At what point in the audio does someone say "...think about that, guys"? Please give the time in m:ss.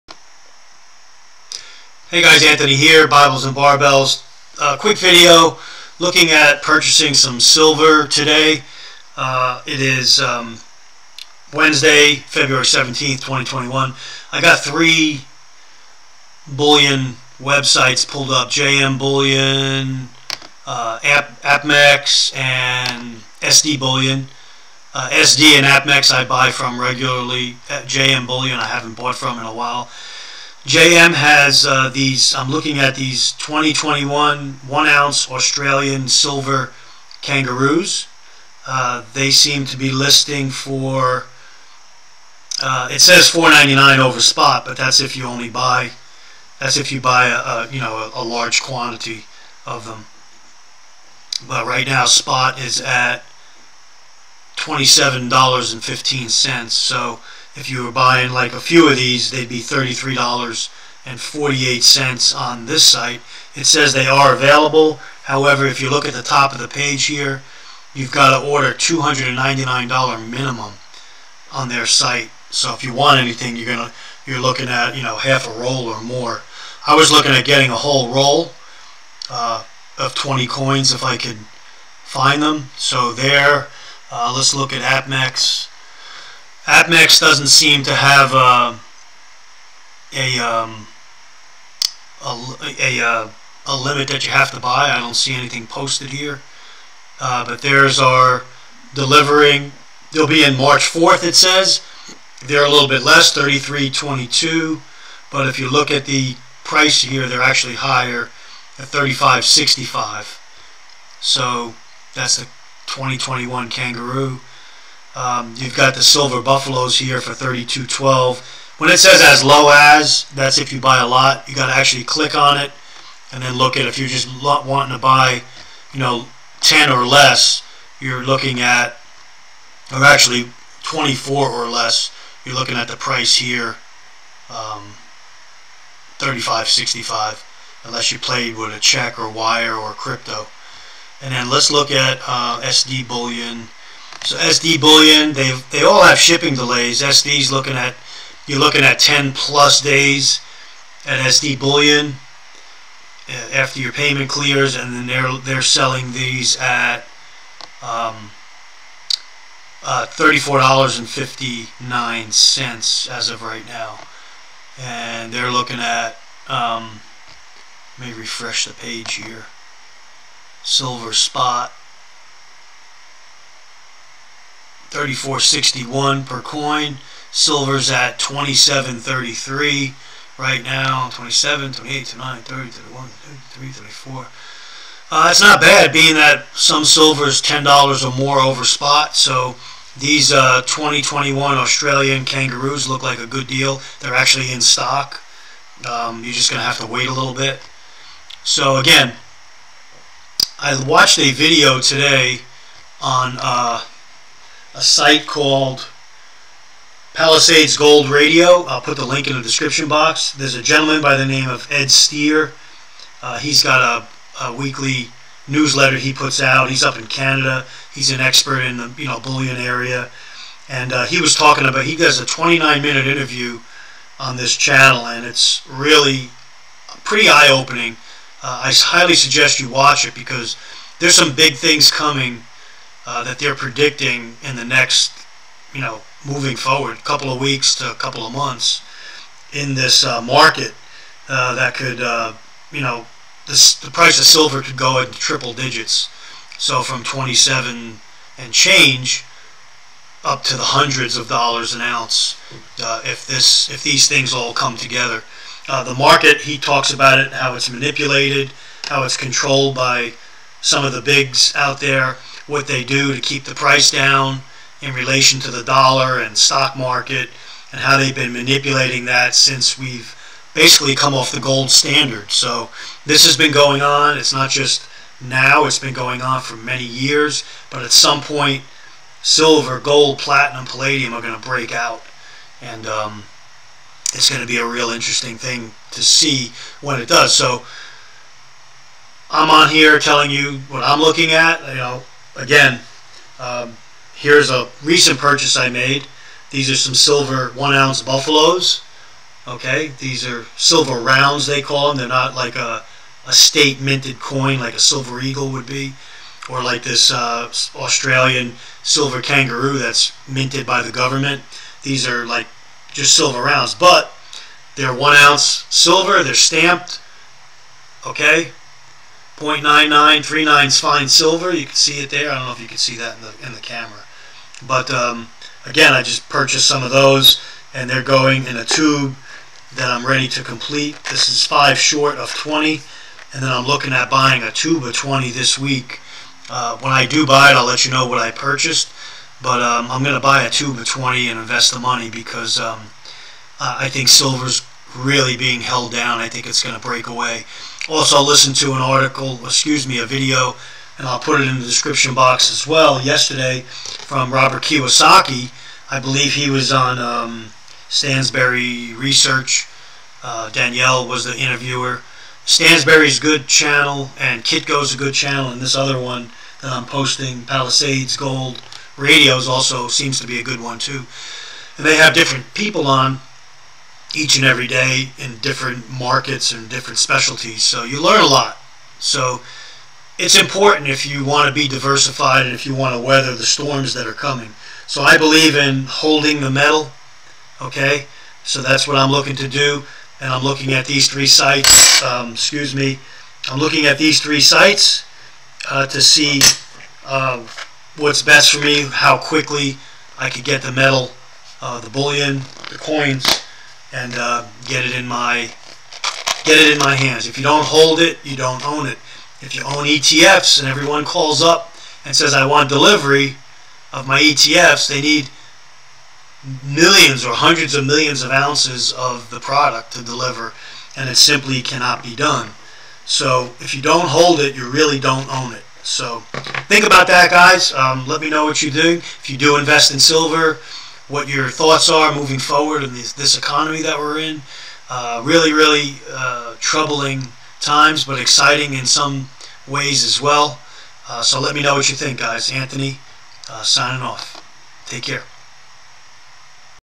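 7:06.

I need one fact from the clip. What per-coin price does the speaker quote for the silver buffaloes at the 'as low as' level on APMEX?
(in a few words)
32.12.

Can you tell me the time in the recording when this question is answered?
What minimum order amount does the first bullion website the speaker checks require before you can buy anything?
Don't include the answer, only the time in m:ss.
1:08.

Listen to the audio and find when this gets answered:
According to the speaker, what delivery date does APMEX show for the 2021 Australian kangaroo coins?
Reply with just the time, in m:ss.
1:40.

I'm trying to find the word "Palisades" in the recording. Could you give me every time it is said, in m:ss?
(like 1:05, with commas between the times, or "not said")
3:27, 6:07.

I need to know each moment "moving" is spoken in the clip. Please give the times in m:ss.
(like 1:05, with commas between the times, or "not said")
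3:56, 7:12.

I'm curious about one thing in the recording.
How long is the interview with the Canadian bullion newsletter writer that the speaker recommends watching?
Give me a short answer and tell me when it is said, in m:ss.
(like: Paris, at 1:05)
29 minutes, at 3:42.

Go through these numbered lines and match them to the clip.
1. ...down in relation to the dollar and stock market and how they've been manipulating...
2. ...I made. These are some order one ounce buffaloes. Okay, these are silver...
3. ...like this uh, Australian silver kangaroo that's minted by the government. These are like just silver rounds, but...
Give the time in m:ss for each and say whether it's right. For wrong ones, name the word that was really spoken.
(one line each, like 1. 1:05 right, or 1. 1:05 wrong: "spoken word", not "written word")
1. 4:23 right
2. 4:55 wrong: "silver", not "order"
3. 5:06 right.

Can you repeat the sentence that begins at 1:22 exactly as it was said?
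So there, uh, let's look at APMEX.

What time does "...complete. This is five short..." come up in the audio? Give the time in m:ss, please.
5:30.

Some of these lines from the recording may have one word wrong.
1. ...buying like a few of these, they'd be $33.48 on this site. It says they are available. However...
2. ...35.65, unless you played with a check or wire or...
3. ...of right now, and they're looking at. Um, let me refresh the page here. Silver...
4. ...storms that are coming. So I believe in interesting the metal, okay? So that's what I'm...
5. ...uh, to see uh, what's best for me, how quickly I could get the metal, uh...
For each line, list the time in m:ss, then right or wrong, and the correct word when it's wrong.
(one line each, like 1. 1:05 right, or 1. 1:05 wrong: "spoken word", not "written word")
1. 0:57 right
2. 2:16 right
3. 2:43 right
4. 6:23 wrong: "holding", not "interesting"
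5. 6:35 right.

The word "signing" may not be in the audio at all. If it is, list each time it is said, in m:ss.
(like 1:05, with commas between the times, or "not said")
7:23.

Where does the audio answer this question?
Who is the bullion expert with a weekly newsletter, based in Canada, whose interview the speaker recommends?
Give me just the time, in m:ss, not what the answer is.
3:31.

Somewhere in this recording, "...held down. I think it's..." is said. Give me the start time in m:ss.
5:45.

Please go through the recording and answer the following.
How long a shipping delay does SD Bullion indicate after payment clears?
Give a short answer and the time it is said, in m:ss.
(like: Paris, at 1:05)
10 plus days, at 2:28.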